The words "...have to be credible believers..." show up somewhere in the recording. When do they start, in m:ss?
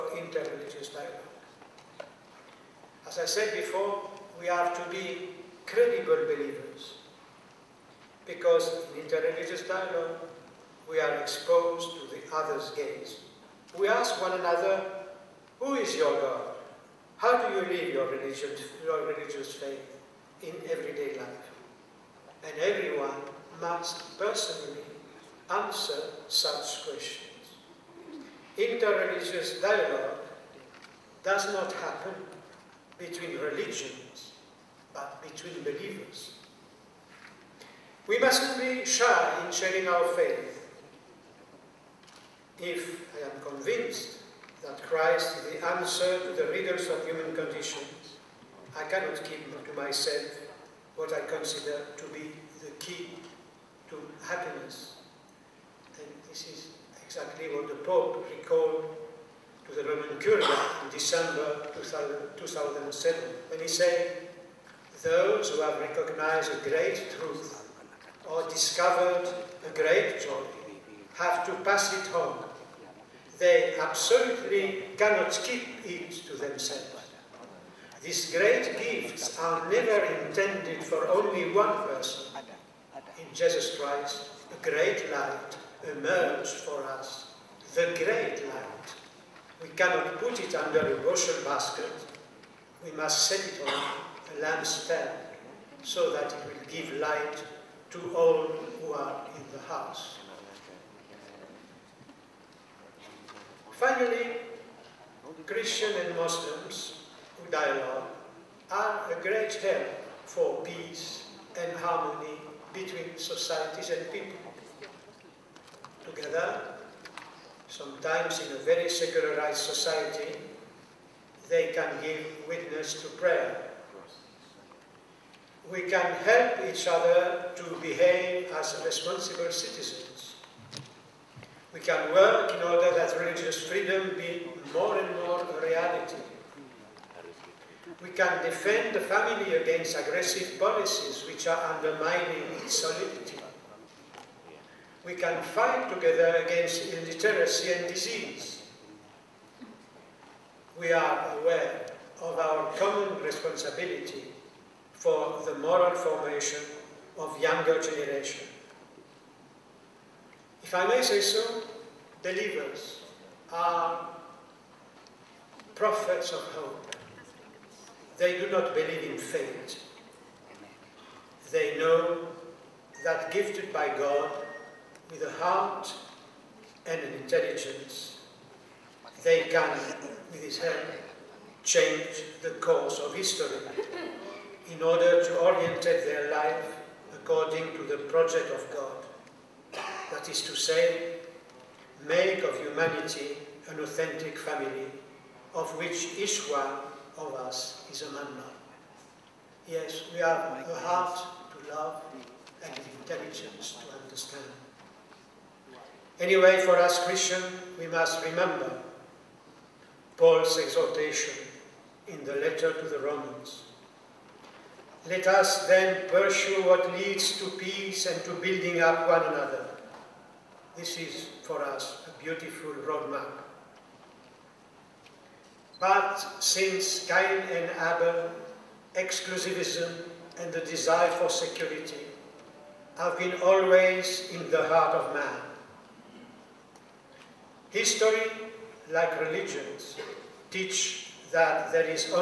0:04.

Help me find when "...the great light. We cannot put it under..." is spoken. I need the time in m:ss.
1:27.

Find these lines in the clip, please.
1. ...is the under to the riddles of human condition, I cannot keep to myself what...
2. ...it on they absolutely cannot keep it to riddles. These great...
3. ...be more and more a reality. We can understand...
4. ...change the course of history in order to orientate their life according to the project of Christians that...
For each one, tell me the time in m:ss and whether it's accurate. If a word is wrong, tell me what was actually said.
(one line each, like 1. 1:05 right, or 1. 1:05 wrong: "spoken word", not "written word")
1. 0:45 wrong: "answer", not "under"
2. 1:11 wrong: "themselves", not "riddles"
3. 2:14 wrong: "defend", not "understand"
4. 3:01 wrong: "God", not "Christians".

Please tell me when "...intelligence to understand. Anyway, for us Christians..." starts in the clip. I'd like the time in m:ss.
3:22.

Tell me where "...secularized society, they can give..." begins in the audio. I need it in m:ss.
1:58.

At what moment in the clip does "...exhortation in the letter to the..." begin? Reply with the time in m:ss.
3:30.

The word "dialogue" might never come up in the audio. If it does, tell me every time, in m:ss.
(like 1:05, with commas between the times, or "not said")
0:00, 0:09, 0:29, 1:47.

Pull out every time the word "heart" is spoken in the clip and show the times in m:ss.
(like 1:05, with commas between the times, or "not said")
2:55, 3:20, 3:54.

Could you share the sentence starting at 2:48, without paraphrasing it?
They do not believe in fate.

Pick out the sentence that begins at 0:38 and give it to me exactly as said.
We mustn't be shy in sharing our faith.